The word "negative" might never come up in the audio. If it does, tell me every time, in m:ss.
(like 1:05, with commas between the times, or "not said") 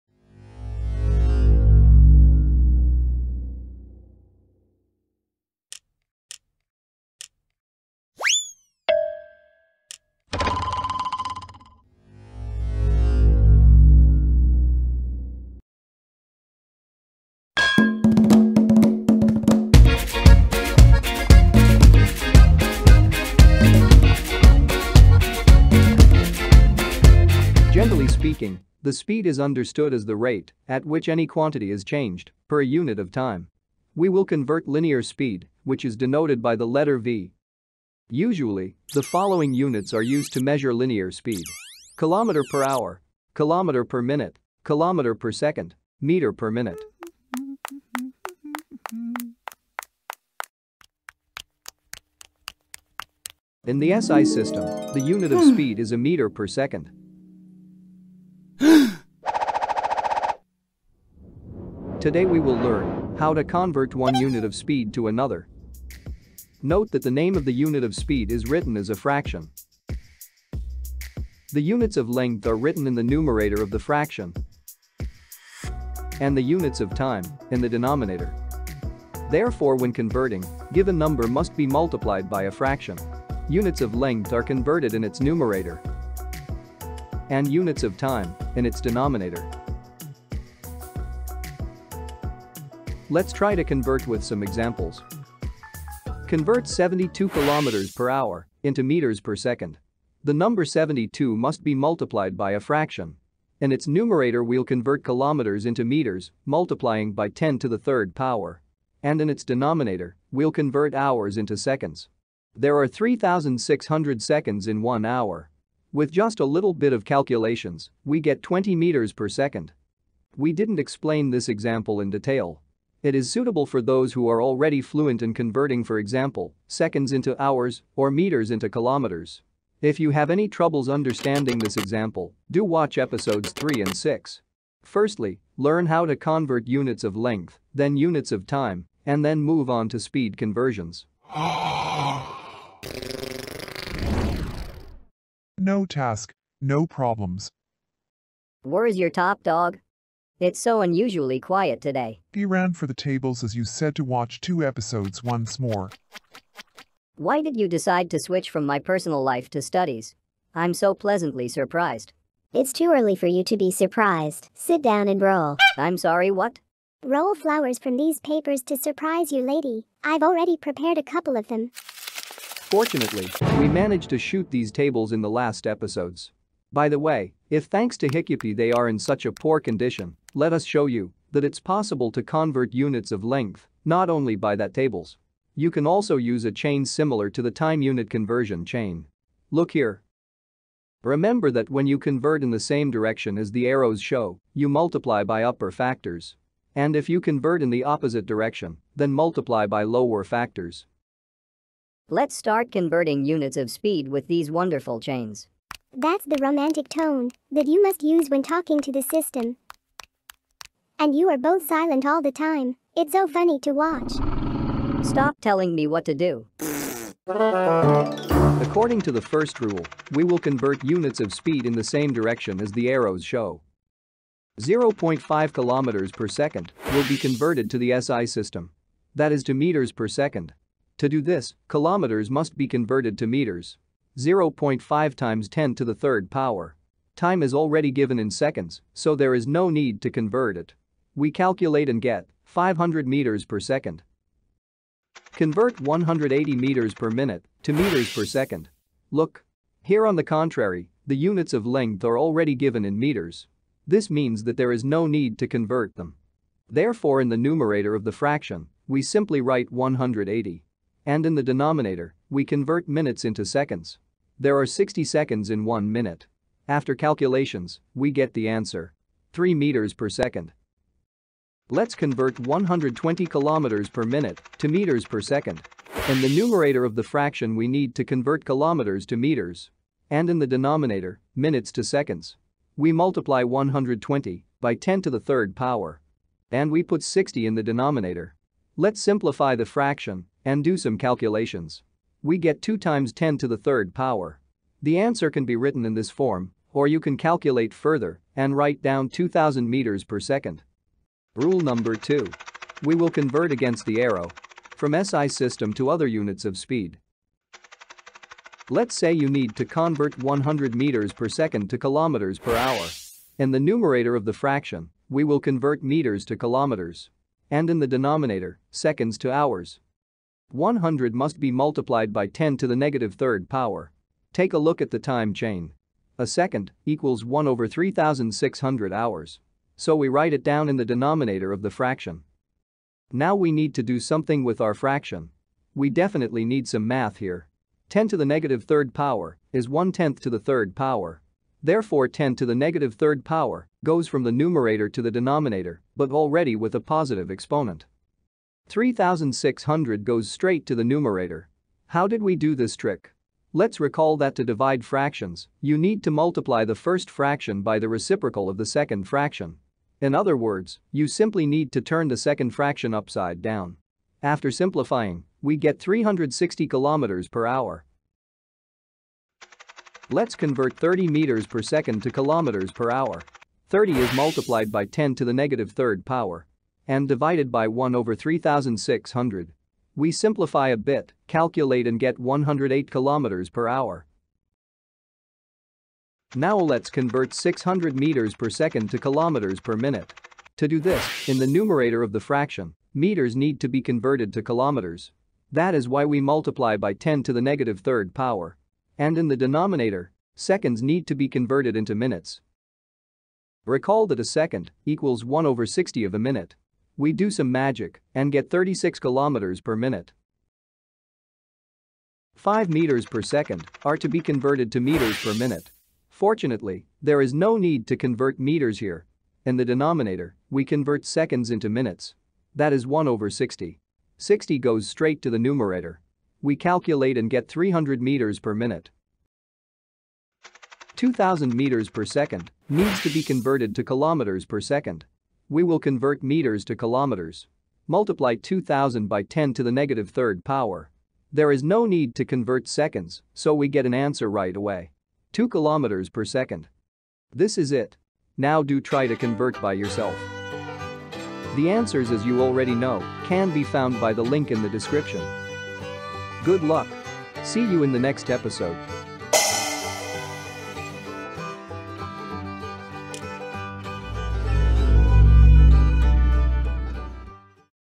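5:22, 5:38, 5:42, 6:15, 6:37, 7:19.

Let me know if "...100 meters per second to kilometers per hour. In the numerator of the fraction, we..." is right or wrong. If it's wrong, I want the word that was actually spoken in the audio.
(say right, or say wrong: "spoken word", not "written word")
right.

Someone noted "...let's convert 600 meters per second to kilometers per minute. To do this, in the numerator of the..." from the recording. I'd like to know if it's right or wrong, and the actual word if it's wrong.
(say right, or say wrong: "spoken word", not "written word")
right.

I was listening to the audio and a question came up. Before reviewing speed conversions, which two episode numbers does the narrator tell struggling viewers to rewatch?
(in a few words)
3 and 6.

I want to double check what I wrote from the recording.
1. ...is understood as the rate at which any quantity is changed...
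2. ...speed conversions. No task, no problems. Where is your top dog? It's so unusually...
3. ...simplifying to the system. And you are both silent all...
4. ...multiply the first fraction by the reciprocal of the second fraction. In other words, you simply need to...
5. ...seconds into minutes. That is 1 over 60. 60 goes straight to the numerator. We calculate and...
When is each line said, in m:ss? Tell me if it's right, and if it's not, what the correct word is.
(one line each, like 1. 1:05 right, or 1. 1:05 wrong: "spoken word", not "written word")
1. 0:29 right
2. 2:19 right
3. 3:28 wrong: "talking", not "simplifying"
4. 5:56 right
5. 7:01 right.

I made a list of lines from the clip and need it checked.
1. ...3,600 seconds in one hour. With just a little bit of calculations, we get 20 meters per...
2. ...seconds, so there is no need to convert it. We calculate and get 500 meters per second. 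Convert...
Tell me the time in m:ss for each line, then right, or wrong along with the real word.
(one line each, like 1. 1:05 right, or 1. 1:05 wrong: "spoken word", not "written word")
1. 1:52 right
2. 3:58 right.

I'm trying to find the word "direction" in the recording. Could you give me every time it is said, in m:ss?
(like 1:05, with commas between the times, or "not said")
3:12, 3:18, 3:42.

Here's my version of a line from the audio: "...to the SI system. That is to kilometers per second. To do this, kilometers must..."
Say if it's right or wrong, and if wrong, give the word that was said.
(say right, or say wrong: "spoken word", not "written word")
wrong: "meters", not "kilometers".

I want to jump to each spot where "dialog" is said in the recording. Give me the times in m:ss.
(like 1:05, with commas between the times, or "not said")
not said.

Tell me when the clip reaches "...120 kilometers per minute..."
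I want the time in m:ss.
4:32.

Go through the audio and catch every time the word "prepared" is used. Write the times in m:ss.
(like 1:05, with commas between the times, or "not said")
2:50.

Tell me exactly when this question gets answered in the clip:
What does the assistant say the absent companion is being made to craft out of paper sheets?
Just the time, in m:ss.
2:47.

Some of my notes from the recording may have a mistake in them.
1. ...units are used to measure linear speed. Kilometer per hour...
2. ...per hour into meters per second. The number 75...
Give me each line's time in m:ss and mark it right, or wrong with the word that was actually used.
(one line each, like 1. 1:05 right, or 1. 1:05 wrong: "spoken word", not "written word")
1. 0:39 right
2. 1:37 wrong: "72", not "75".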